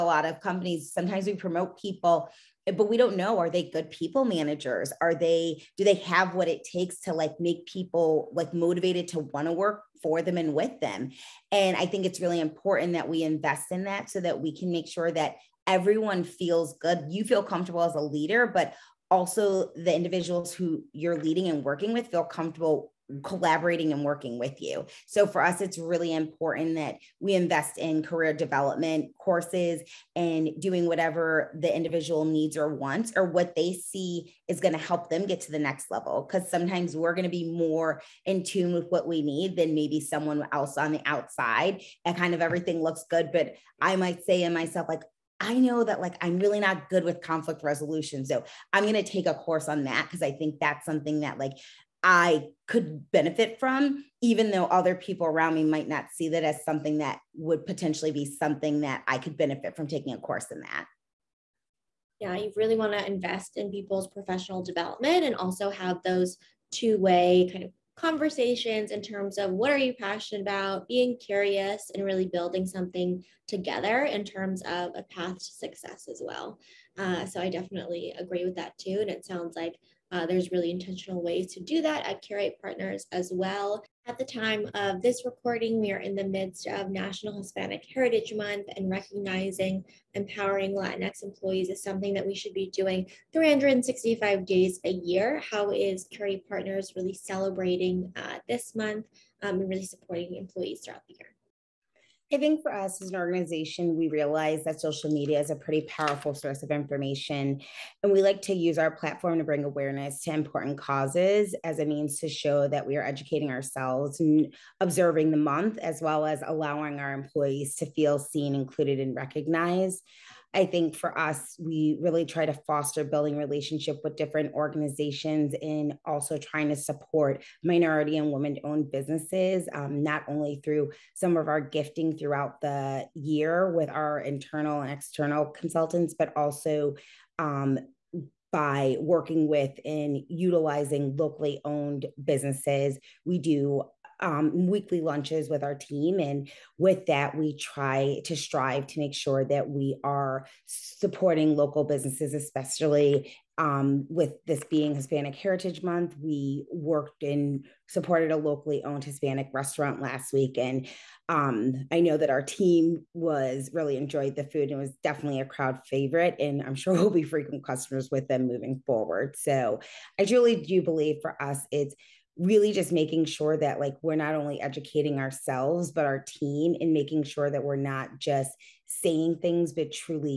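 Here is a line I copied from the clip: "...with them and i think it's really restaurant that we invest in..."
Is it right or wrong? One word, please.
wrong.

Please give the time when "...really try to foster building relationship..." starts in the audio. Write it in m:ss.
2:02.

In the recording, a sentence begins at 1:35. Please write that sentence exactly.
How is Curate Partners really celebrating uh, this month um, and really supporting employees throughout the year?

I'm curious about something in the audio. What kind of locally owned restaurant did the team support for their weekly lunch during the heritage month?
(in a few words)
Hispanic restaurant.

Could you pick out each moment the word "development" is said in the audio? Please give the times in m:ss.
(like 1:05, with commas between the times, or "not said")
0:28, 1:04.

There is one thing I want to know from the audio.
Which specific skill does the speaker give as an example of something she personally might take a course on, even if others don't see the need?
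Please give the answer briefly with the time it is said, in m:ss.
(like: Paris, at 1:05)
Conflict resolution, at 0:47.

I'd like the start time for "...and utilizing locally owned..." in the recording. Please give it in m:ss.
2:19.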